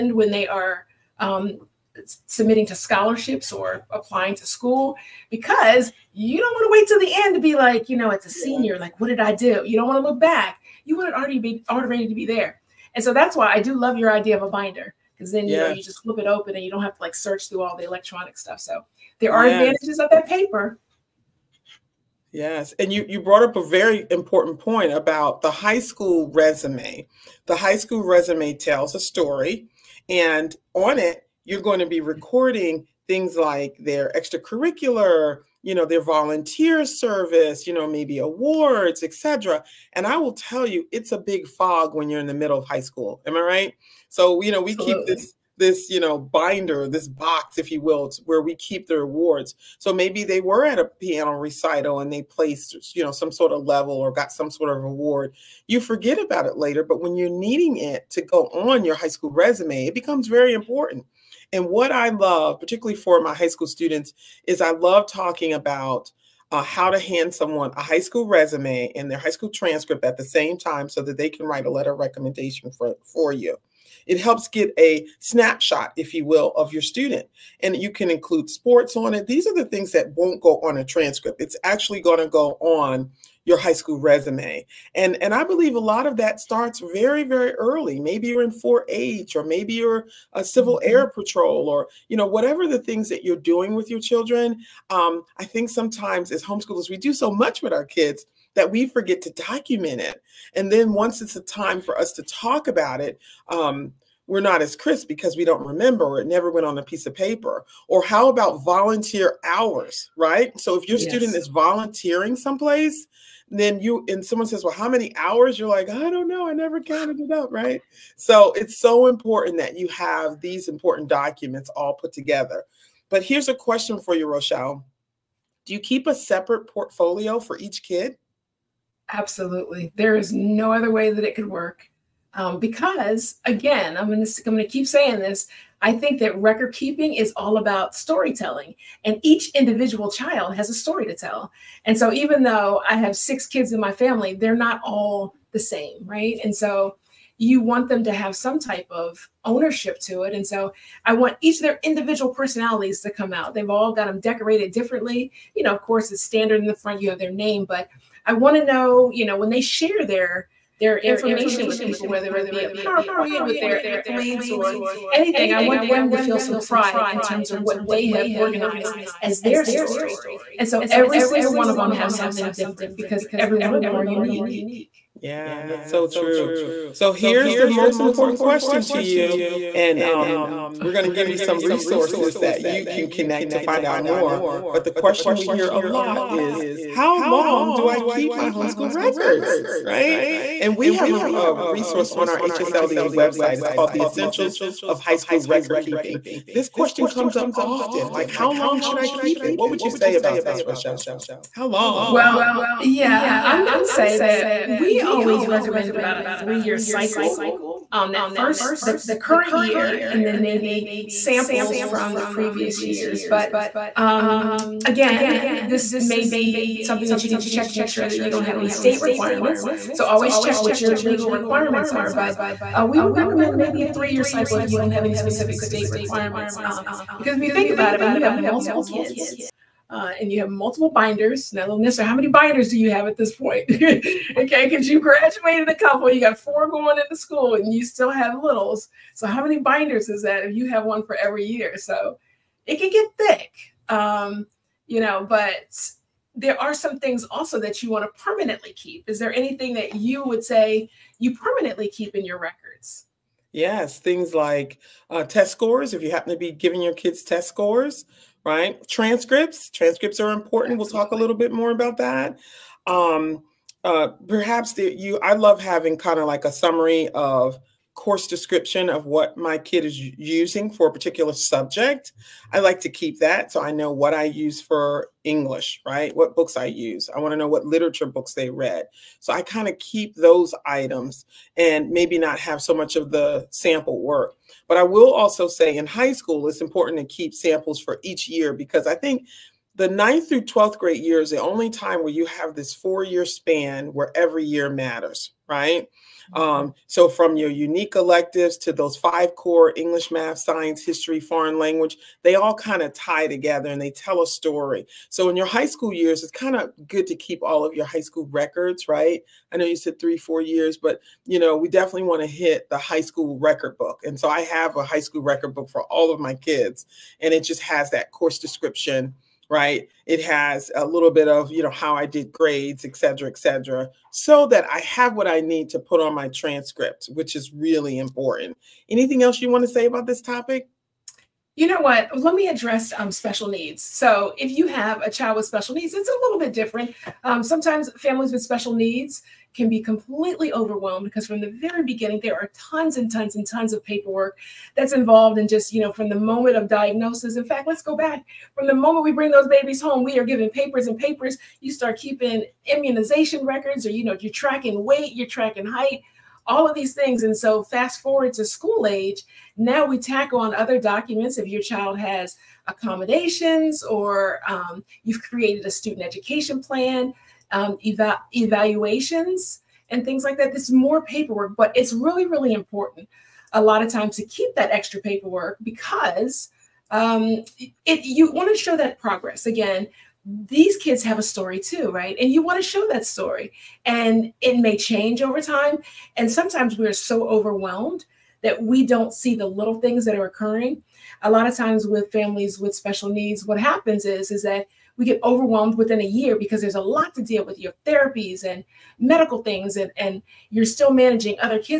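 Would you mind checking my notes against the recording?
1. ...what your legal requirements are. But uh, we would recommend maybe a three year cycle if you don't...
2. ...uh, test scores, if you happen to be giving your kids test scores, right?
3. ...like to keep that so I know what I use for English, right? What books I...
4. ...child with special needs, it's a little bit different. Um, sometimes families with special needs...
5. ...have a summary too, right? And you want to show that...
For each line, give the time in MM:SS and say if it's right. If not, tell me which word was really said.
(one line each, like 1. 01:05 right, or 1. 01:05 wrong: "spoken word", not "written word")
1. 03:40 right
2. 04:15 right
3. 04:32 right
4. 05:35 right
5. 06:21 wrong: "story", not "summary".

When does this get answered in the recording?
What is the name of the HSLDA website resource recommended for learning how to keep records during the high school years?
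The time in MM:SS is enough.
03:13.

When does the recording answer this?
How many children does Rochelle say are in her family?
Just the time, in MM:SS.
02:23.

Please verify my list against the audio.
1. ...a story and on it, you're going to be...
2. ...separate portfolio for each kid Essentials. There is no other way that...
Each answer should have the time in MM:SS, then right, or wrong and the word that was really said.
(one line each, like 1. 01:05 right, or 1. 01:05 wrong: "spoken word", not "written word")
1. 00:28 right
2. 02:06 wrong: "Absolutely", not "Essentials".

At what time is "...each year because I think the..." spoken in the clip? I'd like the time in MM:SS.
04:48.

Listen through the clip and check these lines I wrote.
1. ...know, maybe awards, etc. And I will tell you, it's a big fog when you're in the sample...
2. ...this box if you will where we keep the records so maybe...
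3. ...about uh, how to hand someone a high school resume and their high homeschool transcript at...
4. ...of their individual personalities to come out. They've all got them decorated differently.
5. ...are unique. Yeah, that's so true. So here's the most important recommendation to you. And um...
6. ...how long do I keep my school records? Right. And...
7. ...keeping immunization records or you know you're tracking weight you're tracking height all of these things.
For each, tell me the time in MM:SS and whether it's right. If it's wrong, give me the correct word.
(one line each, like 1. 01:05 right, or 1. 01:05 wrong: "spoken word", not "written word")
1. 00:37 wrong: "middle", not "sample"
2. 00:46 wrong: "awards", not "records"
3. 01:05 wrong: "school", not "homeschool"
4. 02:31 right
5. 02:53 wrong: "question", not "recommendation"
6. 03:06 wrong: "homeschool", not "school"
7. 05:51 right.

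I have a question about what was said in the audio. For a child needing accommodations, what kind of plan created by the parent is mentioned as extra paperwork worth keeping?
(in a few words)
Student education plan.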